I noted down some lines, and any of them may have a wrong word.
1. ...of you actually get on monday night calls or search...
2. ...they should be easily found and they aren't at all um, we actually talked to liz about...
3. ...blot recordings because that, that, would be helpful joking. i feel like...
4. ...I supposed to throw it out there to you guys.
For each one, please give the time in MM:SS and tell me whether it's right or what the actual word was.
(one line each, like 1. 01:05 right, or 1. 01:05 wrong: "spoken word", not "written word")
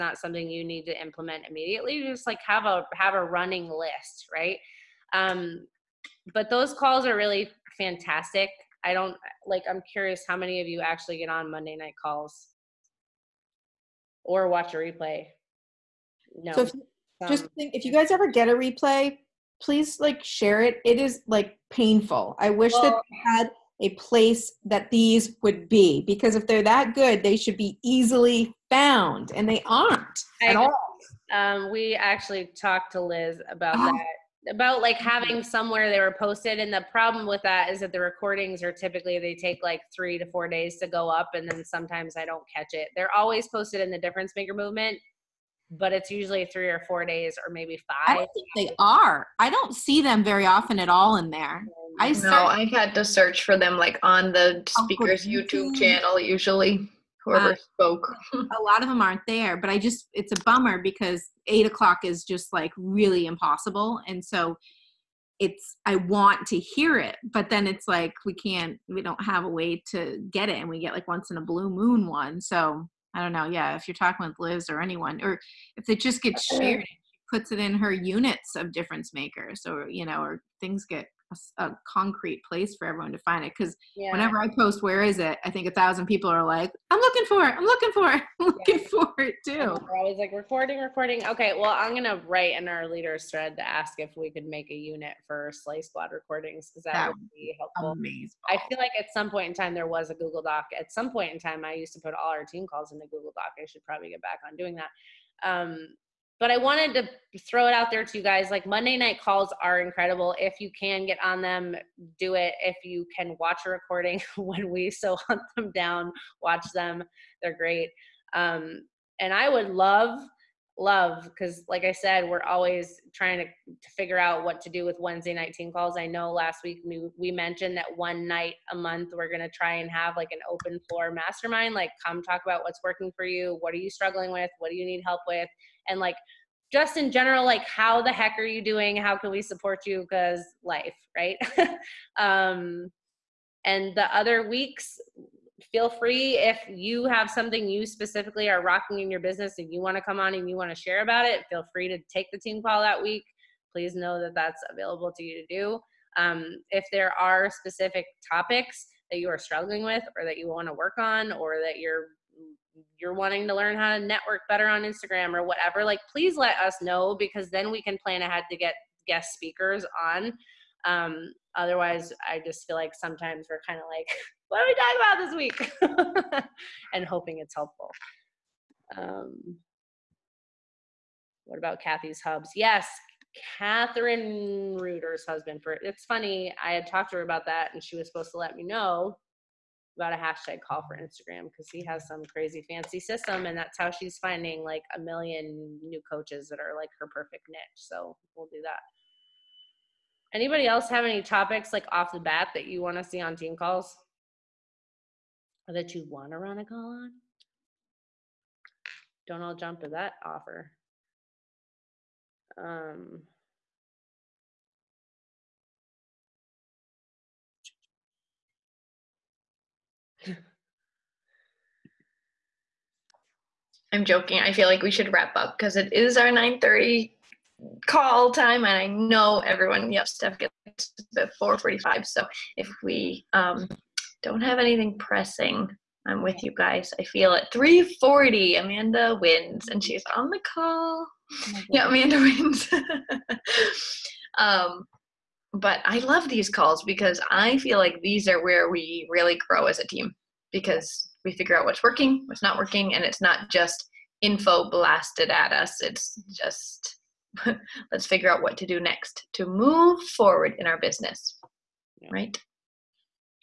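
1. 00:10 wrong: "watch", not "search"
2. 00:27 right
3. 01:35 wrong: "amazing", not "joking"
4. 01:46 wrong: "wanted", not "supposed".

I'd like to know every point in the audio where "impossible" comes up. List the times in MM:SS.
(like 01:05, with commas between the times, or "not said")
01:03.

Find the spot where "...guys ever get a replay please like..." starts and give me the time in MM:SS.
00:17.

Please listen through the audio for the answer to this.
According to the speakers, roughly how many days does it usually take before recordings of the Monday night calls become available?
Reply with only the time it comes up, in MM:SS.
00:39.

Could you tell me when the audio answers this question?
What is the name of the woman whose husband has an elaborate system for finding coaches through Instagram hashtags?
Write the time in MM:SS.
03:03.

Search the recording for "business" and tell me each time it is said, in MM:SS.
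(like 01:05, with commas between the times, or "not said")
02:29, 04:20.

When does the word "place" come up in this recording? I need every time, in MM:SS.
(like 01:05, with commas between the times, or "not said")
00:23, 01:22.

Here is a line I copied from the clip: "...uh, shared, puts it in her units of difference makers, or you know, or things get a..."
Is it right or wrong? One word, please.
right.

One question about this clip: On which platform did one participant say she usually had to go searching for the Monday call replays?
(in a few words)
YouTube.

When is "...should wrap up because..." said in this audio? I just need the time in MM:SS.
03:44.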